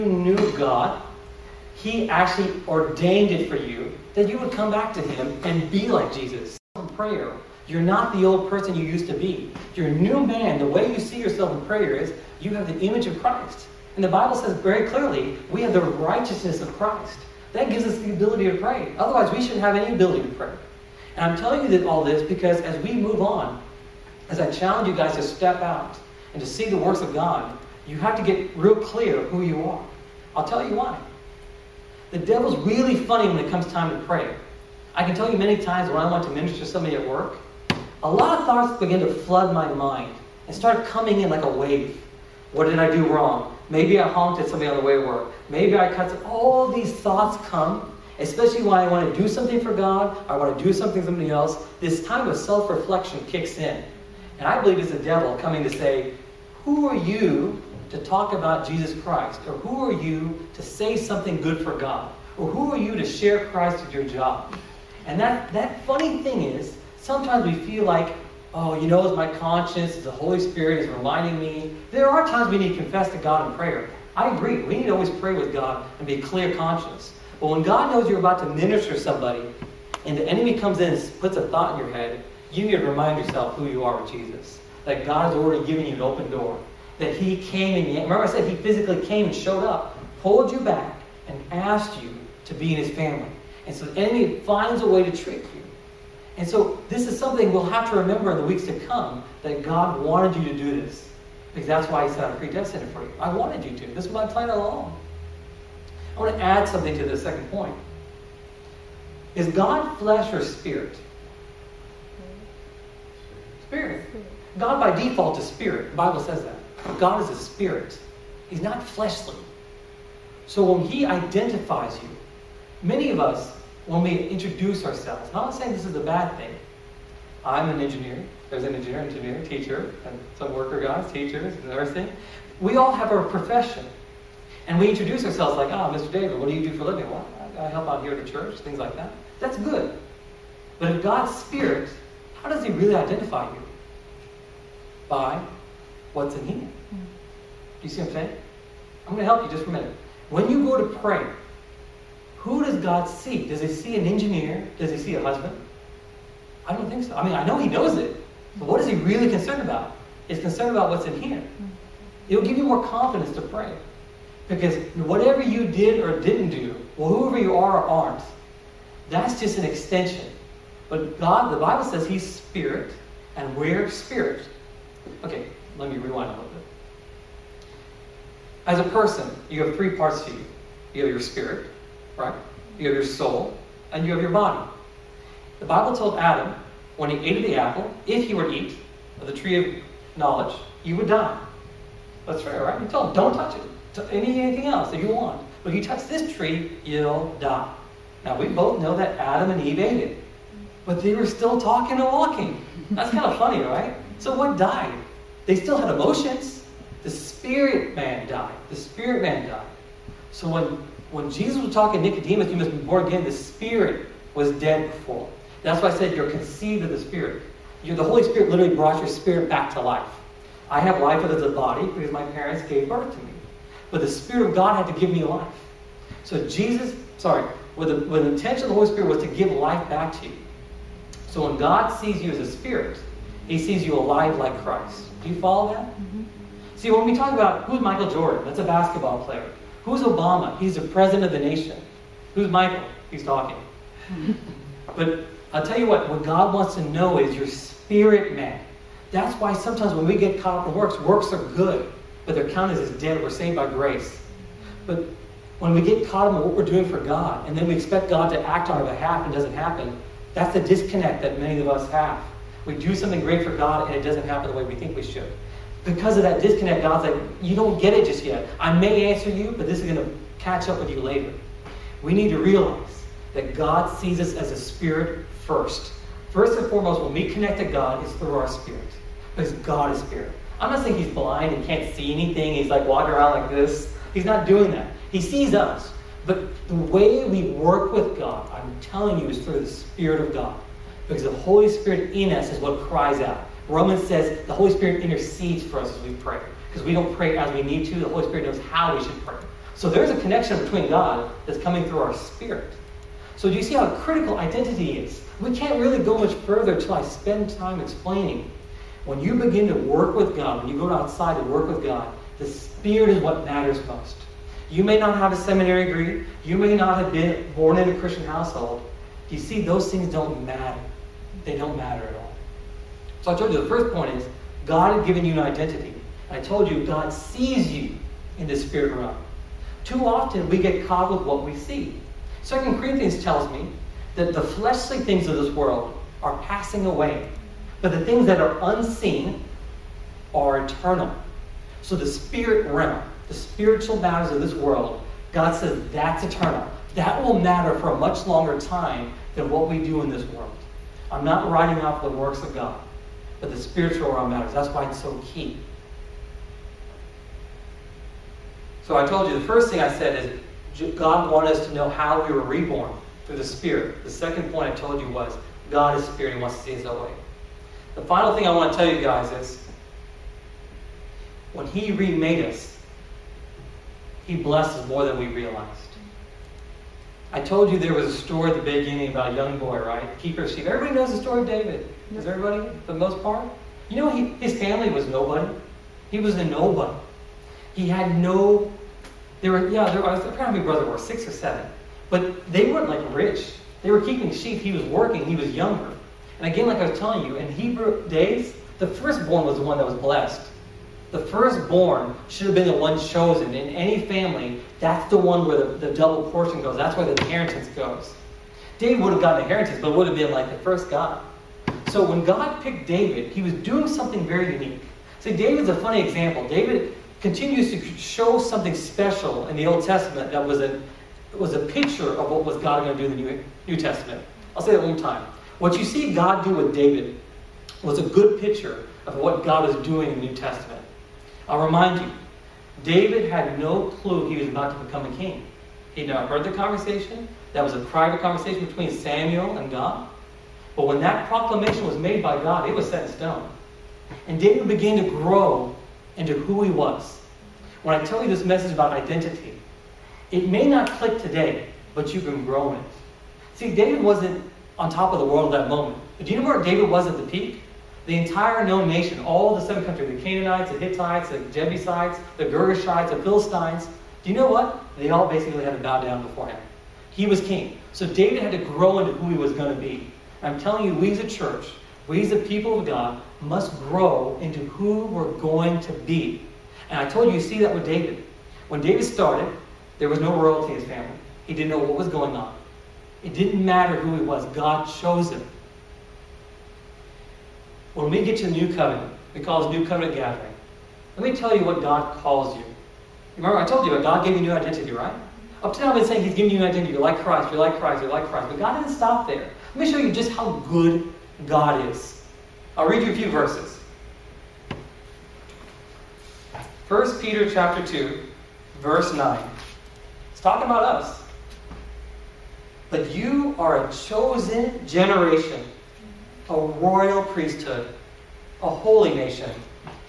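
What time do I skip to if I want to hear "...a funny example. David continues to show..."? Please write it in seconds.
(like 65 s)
415 s.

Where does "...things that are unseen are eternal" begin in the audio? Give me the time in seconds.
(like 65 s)
338 s.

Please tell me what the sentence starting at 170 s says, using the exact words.
But God, the Bible says He's spirit, and we're spirit.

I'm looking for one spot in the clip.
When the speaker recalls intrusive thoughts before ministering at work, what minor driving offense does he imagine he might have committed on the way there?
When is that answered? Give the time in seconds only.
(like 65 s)
44 s.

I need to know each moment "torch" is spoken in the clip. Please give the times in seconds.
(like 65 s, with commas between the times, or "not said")
not said.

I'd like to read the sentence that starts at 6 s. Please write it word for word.
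In prayer, you're not the old person you used to be.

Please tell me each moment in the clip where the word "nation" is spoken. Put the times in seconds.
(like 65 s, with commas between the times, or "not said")
241 s, 458 s, 519 s.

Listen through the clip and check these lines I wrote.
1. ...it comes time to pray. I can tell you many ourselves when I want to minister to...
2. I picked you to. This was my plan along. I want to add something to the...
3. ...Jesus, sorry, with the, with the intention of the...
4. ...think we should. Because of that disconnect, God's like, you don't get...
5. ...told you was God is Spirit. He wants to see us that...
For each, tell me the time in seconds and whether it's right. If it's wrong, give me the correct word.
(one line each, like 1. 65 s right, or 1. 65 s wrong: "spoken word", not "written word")
1. 33 s wrong: "times", not "ourselves"
2. 103 s wrong: "wanted", not "picked"
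3. 226 s right
4. 264 s right
5. 364 s right.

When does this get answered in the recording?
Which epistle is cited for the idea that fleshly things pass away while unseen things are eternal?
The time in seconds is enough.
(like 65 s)
332 s.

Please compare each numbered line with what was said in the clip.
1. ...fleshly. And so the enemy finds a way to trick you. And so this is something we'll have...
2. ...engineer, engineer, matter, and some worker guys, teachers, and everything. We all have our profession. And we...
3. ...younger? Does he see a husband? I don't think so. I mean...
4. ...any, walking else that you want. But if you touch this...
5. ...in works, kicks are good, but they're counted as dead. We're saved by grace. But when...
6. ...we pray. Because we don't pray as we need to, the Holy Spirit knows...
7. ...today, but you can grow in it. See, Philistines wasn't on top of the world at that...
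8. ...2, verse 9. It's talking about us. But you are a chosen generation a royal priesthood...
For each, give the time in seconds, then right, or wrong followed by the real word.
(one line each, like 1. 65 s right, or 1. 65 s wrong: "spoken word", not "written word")
1. 92 s wrong: "family", not "fleshly"
2. 128 s wrong: "teacher", not "matter"
3. 154 s wrong: "engineer", not "younger"
4. 194 s wrong: "anything", not "walking"
5. 250 s wrong: "works", not "kicks"
6. 296 s right
7. 451 s wrong: "David", not "Philistines"
8. 507 s right.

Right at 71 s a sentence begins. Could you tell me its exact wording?
There are times we need to confess to God in prayer.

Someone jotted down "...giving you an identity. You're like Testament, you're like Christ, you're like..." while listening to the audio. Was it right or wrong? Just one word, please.
wrong.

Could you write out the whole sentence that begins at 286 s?
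But the way we work with God, I'm telling you, is through the Spirit of God.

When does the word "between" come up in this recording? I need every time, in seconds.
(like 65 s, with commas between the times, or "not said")
300 s, 438 s.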